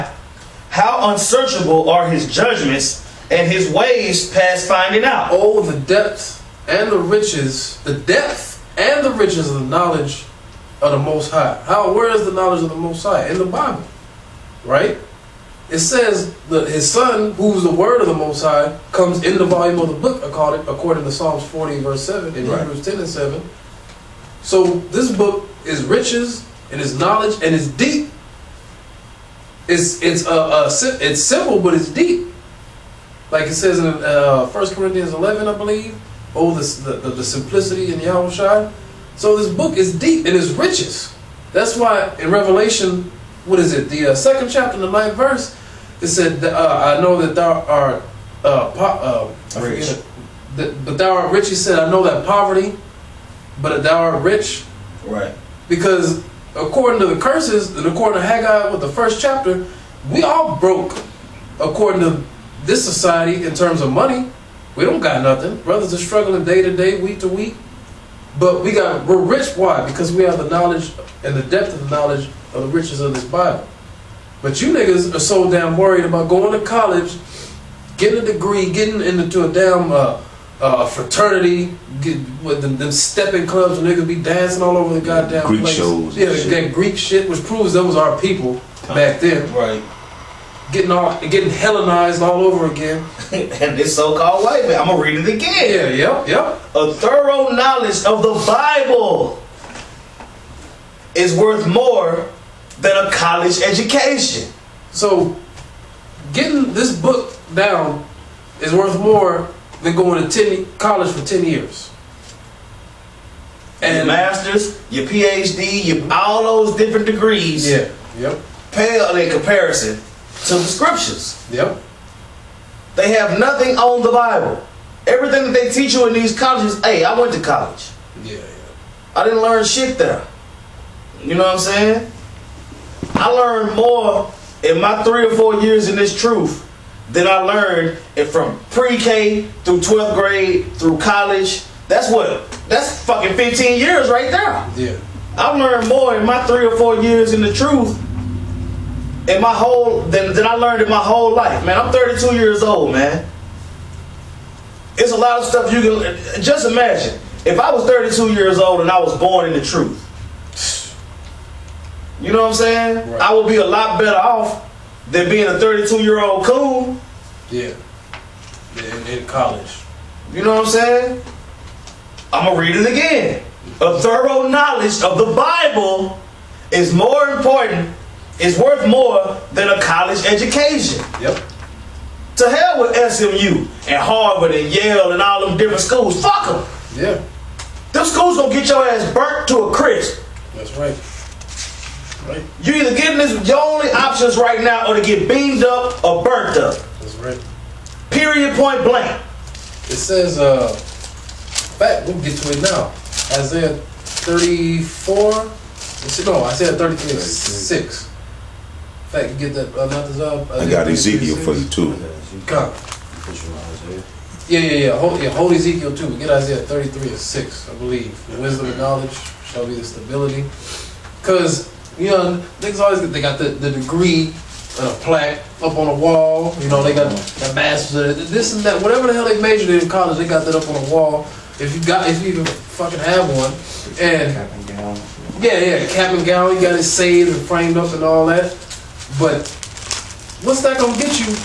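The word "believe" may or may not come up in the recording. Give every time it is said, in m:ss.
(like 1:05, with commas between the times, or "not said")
0:35, 3:37.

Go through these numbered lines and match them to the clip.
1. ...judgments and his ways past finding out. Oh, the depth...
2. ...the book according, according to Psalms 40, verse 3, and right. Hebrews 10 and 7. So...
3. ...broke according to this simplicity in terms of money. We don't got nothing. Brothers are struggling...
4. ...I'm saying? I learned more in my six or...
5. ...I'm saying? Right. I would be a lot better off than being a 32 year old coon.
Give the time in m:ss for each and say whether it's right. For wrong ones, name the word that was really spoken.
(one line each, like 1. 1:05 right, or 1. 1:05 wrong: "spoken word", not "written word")
1. 0:02 right
2. 0:19 wrong: "7", not "3"
3. 1:00 wrong: "society", not "simplicity"
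4. 2:11 wrong: "three", not "six"
5. 2:42 right.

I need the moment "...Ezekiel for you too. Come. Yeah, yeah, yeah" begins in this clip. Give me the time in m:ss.
3:30.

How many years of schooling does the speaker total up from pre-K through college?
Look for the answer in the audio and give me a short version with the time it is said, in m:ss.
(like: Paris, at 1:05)
15, at 2:23.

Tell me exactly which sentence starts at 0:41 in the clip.
That's why in Revelation, what is it?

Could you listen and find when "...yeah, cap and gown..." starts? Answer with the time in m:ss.
3:55.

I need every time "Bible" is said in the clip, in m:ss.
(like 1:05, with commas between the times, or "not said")
0:13, 1:13, 1:38, 2:04, 2:55.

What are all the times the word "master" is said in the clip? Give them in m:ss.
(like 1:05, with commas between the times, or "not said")
1:54, 3:47.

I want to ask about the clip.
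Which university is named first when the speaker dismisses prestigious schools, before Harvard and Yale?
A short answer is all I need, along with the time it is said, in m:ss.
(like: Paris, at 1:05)
SMU, at 3:03.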